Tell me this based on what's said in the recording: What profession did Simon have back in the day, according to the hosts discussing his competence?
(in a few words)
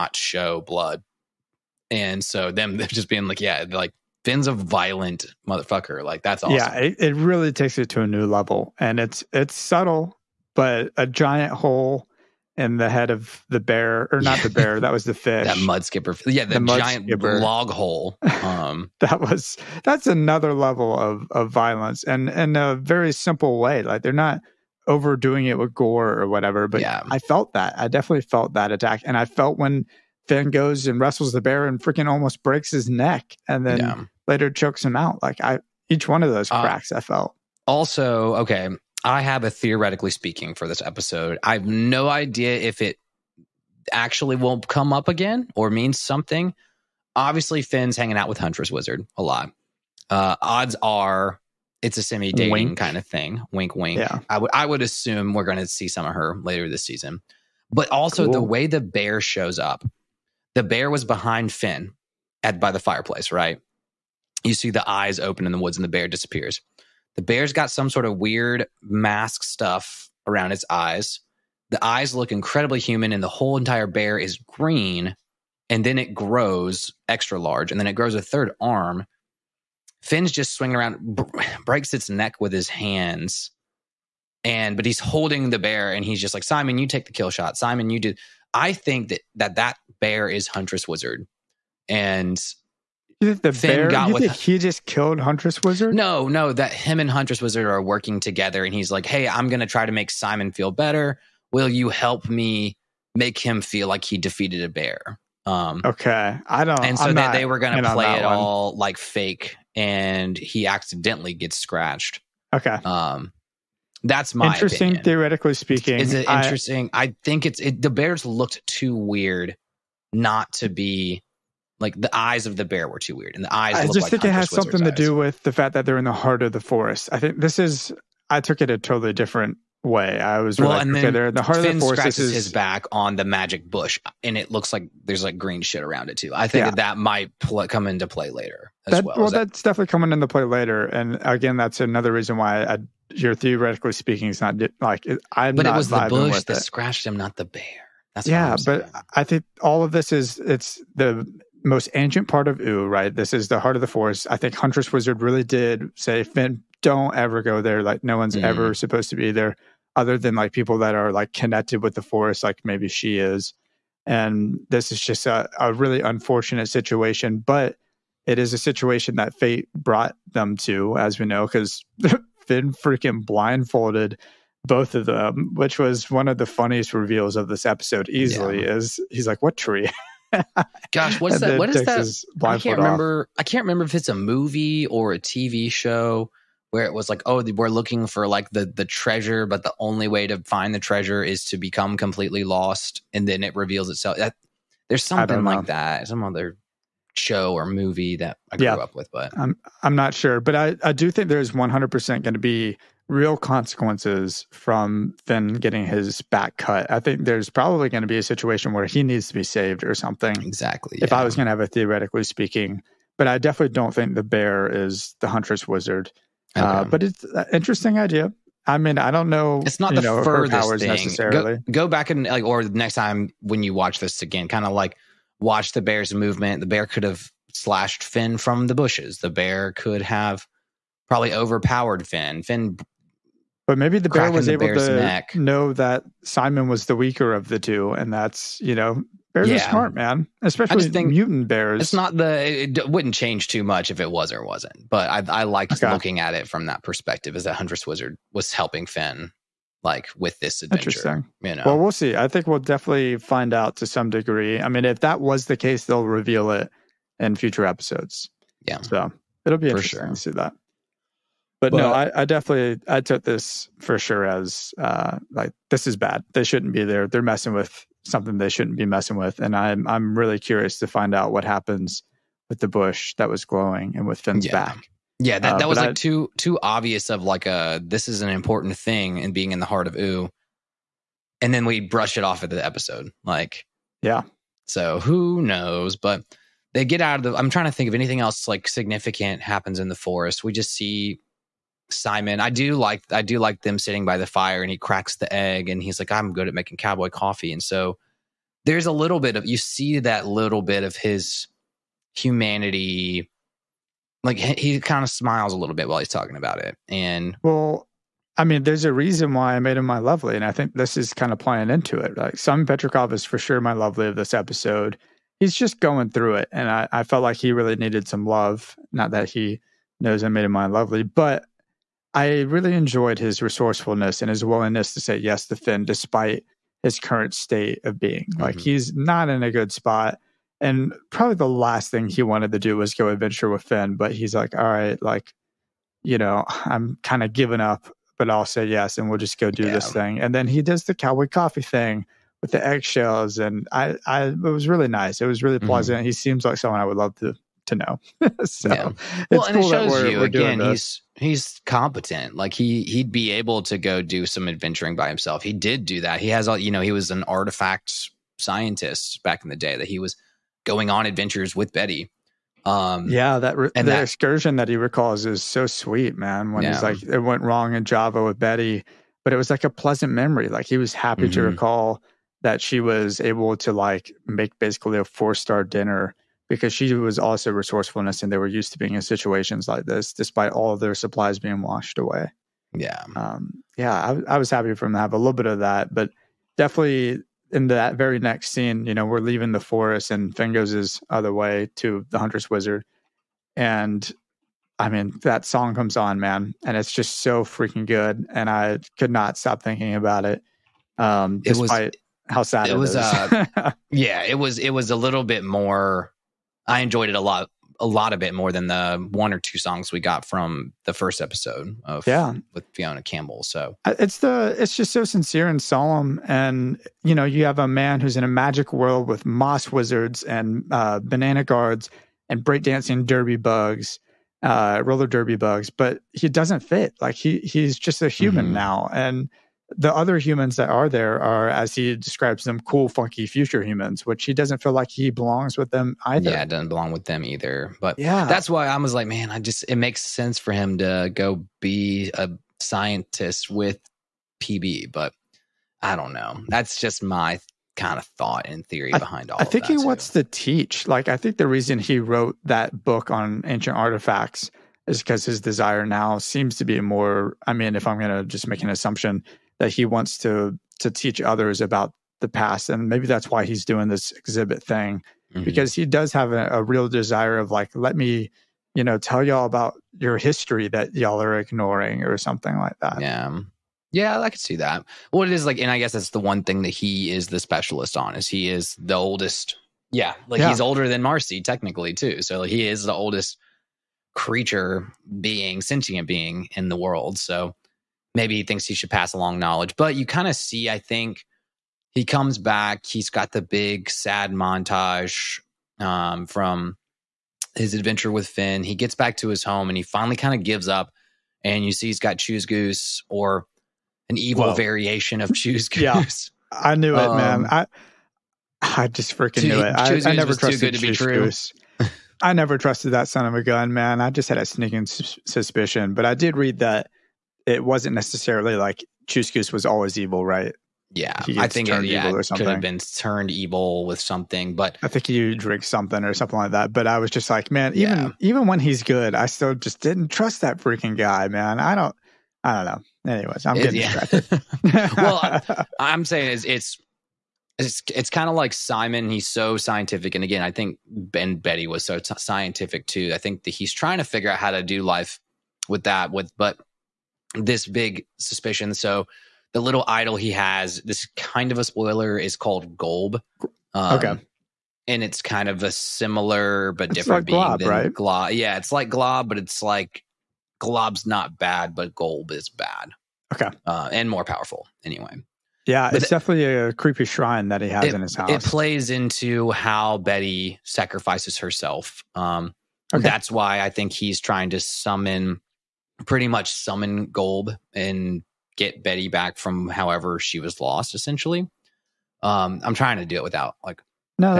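Artifact scientist.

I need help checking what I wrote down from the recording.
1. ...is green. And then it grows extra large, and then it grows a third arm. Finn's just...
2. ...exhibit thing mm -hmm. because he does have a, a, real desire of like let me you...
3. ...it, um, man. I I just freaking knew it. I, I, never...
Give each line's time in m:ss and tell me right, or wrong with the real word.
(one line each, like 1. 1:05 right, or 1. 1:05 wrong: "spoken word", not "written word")
1. 1:14 right
2. 7:44 right
3. 8:26 right.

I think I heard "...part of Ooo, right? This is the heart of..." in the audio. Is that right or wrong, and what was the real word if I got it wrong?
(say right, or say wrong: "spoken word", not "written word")
right.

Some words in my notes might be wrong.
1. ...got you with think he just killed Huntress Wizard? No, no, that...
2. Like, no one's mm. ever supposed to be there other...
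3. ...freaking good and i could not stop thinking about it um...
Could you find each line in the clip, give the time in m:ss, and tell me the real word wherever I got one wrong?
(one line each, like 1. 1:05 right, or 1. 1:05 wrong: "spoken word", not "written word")
1. 1:33 right
2. 2:37 right
3. 6:37 right.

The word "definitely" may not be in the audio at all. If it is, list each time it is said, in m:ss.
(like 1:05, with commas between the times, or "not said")
0:27, 2:19, 3:33, 4:12, 4:22, 6:26, 9:26.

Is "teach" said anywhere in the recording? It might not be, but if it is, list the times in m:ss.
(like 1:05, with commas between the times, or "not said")
7:30, 7:40.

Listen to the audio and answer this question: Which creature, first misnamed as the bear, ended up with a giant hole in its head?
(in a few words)
Mud skipper.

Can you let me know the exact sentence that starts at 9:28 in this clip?
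It plays into how Betty sacrifices herself.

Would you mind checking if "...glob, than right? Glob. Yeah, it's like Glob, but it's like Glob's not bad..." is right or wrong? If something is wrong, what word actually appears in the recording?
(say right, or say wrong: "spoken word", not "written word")
right.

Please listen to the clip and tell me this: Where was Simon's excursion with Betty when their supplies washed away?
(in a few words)
Java.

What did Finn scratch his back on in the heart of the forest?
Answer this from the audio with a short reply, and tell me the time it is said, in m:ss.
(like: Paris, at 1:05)
The magic bush, at 2:13.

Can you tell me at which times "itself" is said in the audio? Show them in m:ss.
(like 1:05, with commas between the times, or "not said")
3:13.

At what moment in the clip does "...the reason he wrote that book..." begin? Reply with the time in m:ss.
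7:31.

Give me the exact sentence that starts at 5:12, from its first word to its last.
Like Simon Petrikov is for sure my lovely of this episode.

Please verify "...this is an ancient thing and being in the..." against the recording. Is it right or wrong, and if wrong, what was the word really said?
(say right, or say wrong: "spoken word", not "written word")
wrong: "important", not "ancient".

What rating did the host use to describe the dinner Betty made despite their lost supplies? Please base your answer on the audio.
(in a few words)
Four star.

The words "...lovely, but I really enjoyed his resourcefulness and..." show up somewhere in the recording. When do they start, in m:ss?
5:20.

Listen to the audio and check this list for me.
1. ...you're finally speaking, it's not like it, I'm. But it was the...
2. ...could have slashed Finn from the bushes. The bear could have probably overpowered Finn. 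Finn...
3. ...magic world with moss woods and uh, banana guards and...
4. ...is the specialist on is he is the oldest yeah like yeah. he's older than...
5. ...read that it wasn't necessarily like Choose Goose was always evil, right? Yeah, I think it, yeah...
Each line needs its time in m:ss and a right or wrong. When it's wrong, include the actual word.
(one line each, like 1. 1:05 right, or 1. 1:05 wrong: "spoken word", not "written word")
1. 2:23 wrong: "theoretically", not "finally"
2. 3:46 right
3. 6:58 wrong: "wizards", not "woods"
4. 7:57 right
5. 8:36 right.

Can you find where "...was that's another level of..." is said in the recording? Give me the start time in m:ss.
0:19.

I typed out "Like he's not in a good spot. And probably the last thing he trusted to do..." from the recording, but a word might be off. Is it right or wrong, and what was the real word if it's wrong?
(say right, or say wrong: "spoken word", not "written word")
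wrong: "wanted", not "trusted".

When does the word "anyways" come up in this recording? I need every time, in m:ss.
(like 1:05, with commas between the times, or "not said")
8:53, 9:24.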